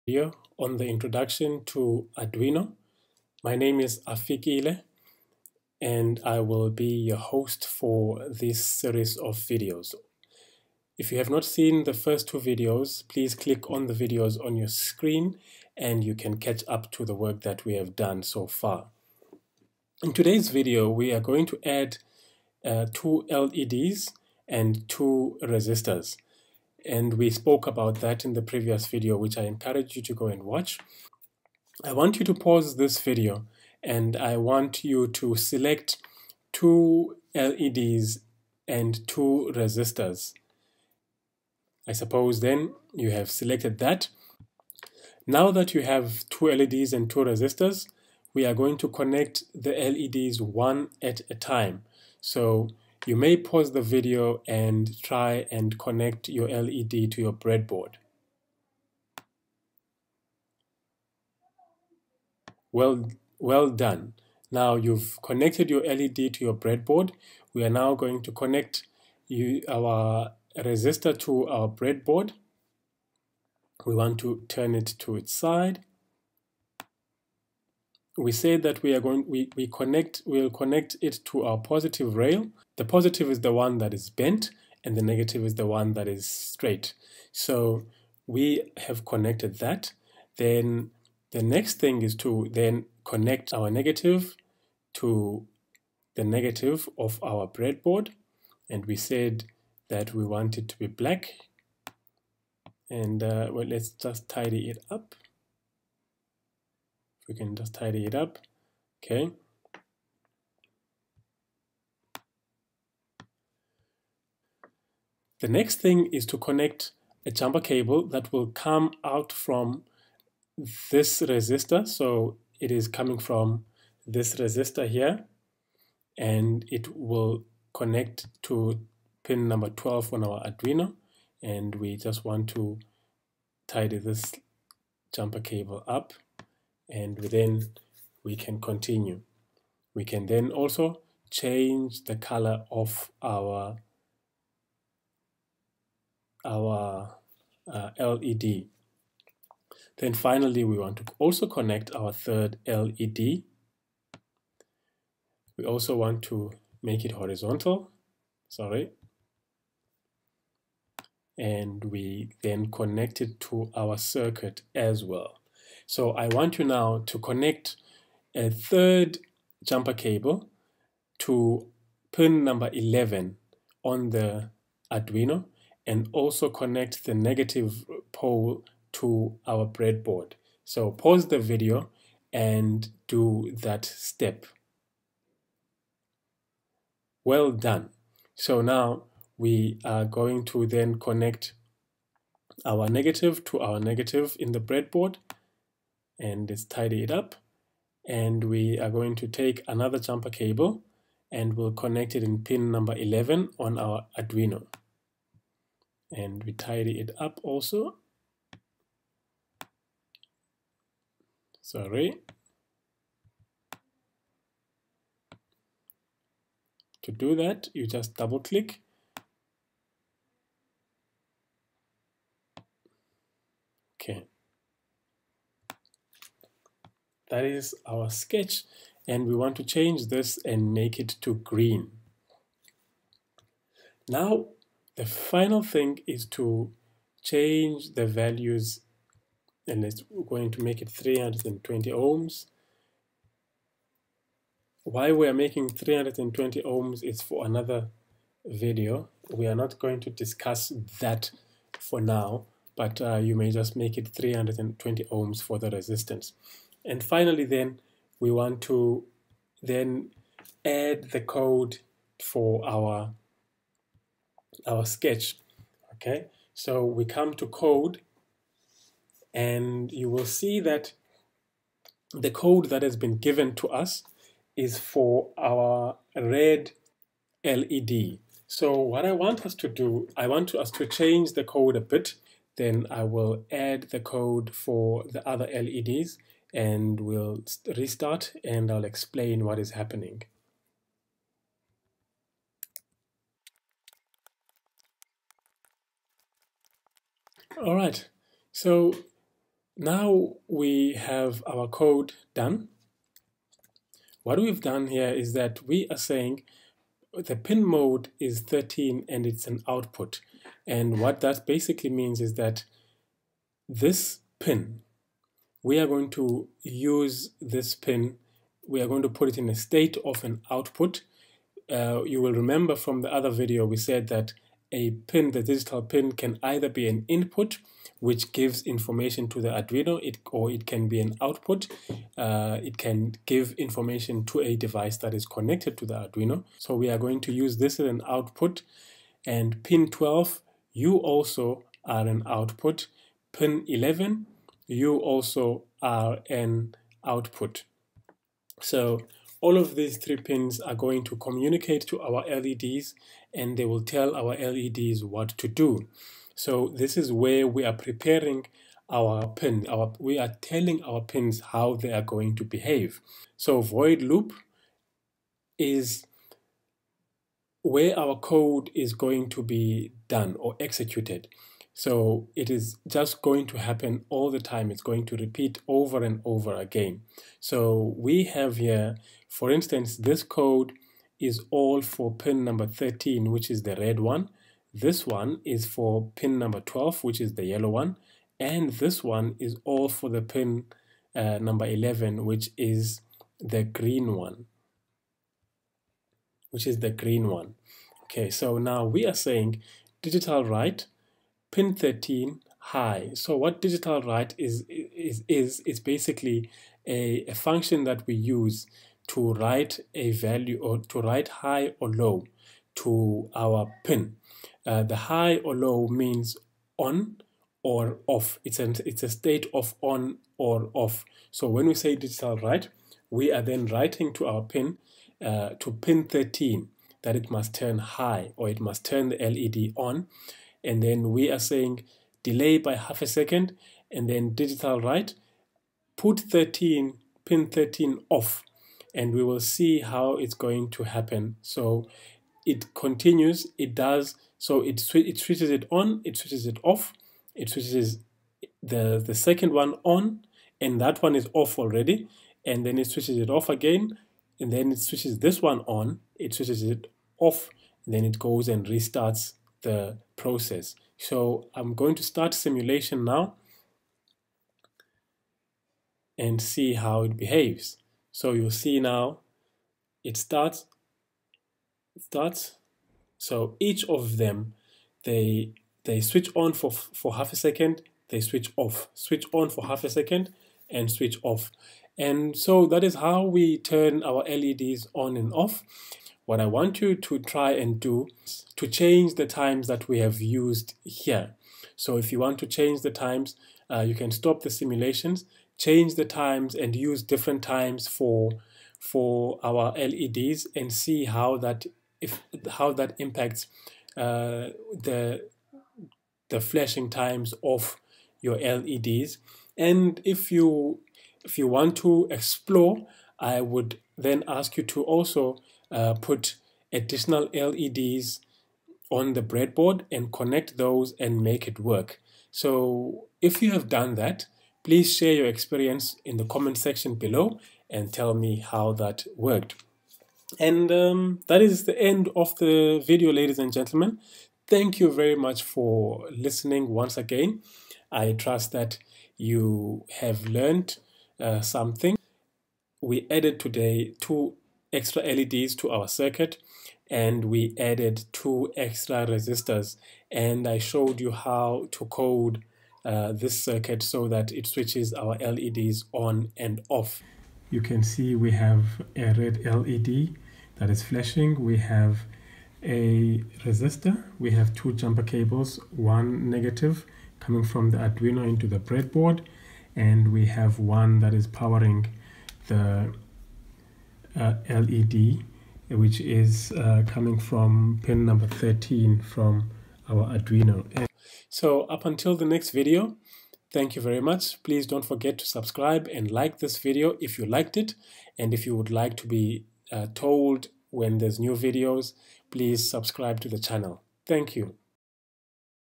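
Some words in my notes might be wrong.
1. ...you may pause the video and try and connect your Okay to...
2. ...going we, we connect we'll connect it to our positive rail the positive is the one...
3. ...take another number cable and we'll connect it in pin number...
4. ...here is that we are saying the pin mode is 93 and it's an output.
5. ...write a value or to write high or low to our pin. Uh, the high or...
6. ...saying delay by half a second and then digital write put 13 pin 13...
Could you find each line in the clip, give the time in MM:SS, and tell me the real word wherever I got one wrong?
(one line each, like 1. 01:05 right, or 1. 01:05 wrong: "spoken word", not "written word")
1. 00:53 wrong: "LED", not "Okay"
2. 01:18 right
3. 03:19 wrong: "jumper", not "number"
4. 05:04 wrong: "13", not "93"
5. 06:49 right
6. 07:11 right.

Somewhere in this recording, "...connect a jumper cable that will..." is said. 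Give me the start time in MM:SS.
01:56.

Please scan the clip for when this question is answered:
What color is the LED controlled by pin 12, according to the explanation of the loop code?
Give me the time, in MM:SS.
06:27.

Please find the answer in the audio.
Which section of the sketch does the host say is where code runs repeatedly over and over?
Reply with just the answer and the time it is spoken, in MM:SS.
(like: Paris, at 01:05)
void loop, at 06:03.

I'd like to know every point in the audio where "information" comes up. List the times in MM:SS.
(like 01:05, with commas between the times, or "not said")
05:28, 05:33.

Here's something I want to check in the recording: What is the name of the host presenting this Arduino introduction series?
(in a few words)
Afikile.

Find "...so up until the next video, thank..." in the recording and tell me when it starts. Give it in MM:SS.
09:41.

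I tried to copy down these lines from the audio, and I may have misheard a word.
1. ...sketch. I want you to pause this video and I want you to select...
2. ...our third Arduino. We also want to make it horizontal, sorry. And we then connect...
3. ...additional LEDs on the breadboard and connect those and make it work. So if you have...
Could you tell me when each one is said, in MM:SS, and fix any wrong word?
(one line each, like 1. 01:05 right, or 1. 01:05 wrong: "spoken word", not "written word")
1. 00:30 wrong: "watch", not "sketch"
2. 02:31 wrong: "LED", not "Arduino"
3. 08:36 right.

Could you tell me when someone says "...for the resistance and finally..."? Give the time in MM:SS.
04:15.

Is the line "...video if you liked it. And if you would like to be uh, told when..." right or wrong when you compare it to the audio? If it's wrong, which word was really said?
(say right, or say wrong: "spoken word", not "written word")
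right.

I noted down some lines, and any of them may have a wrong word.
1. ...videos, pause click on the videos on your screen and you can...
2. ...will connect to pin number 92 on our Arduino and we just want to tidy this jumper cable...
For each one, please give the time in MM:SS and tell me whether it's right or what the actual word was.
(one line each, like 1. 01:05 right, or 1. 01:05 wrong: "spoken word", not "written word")
1. 00:12 wrong: "please", not "pause"
2. 02:06 wrong: "12", not "92".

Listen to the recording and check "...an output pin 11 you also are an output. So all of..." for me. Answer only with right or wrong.
right.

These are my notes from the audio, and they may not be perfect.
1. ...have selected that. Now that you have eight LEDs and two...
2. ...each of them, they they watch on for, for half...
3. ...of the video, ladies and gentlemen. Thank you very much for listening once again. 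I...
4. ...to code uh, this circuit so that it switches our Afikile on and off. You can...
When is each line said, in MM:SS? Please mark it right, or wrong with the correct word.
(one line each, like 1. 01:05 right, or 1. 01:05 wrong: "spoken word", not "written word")
1. 00:43 wrong: "two", not "eight"
2. 07:53 wrong: "switch", not "watch"
3. 08:52 right
4. 09:11 wrong: "LEDs", not "Afikile".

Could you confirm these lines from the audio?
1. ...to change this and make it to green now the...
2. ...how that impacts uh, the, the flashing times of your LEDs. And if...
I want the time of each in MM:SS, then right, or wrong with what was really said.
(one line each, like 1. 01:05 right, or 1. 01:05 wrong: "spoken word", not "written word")
1. 03:49 right
2. 08:22 right.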